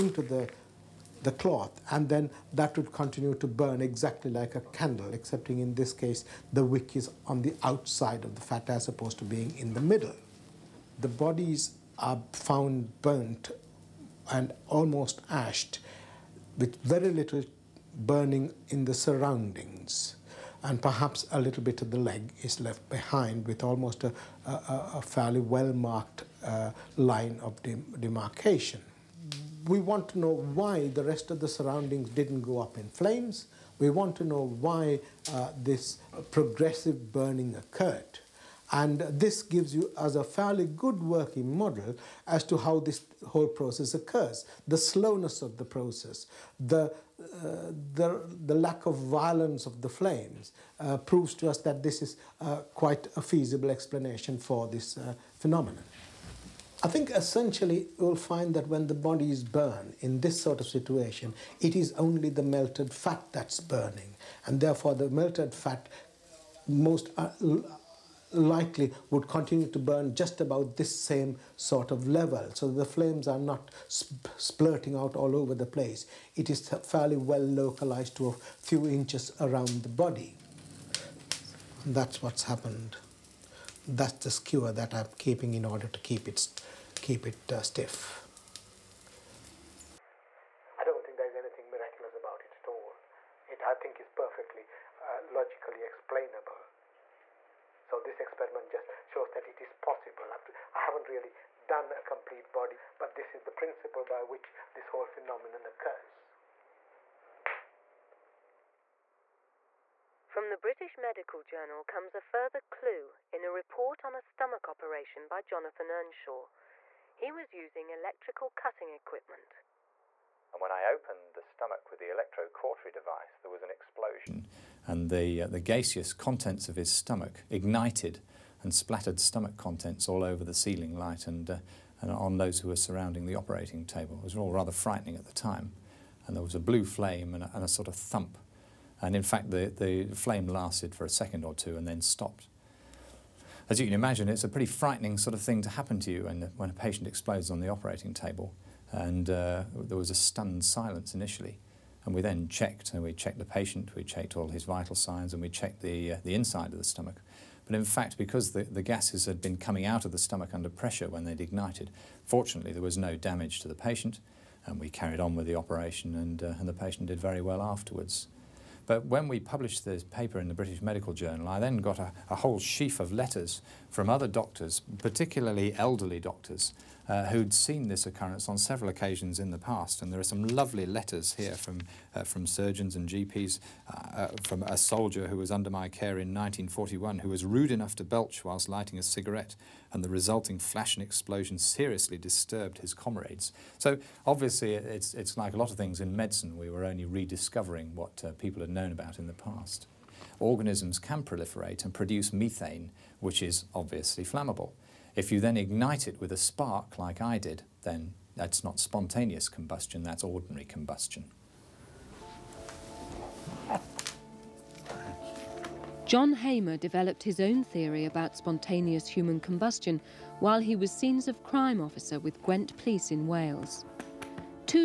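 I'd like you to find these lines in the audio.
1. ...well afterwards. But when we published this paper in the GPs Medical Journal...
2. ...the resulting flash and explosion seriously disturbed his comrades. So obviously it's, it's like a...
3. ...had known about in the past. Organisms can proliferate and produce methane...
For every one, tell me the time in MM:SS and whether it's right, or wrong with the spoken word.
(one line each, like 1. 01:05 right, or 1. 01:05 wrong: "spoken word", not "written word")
1. 02:47 wrong: "British", not "GPs"
2. 03:10 right
3. 03:18 right.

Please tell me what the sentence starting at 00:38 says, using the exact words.
And this gives you as a fairly good working model as to how this whole process occurs.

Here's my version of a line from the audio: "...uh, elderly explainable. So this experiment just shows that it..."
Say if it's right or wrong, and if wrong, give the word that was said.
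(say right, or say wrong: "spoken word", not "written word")
wrong: "logically", not "elderly".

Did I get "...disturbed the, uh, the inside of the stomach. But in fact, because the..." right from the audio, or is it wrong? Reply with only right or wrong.
wrong.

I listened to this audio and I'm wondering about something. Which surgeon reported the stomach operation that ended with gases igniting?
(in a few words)
Jonathan Earnshaw.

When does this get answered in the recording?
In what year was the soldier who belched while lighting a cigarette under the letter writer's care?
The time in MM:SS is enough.
03:06.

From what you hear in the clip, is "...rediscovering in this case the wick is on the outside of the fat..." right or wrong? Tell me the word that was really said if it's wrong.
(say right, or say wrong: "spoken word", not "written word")
wrong: "excepting", not "rediscovering".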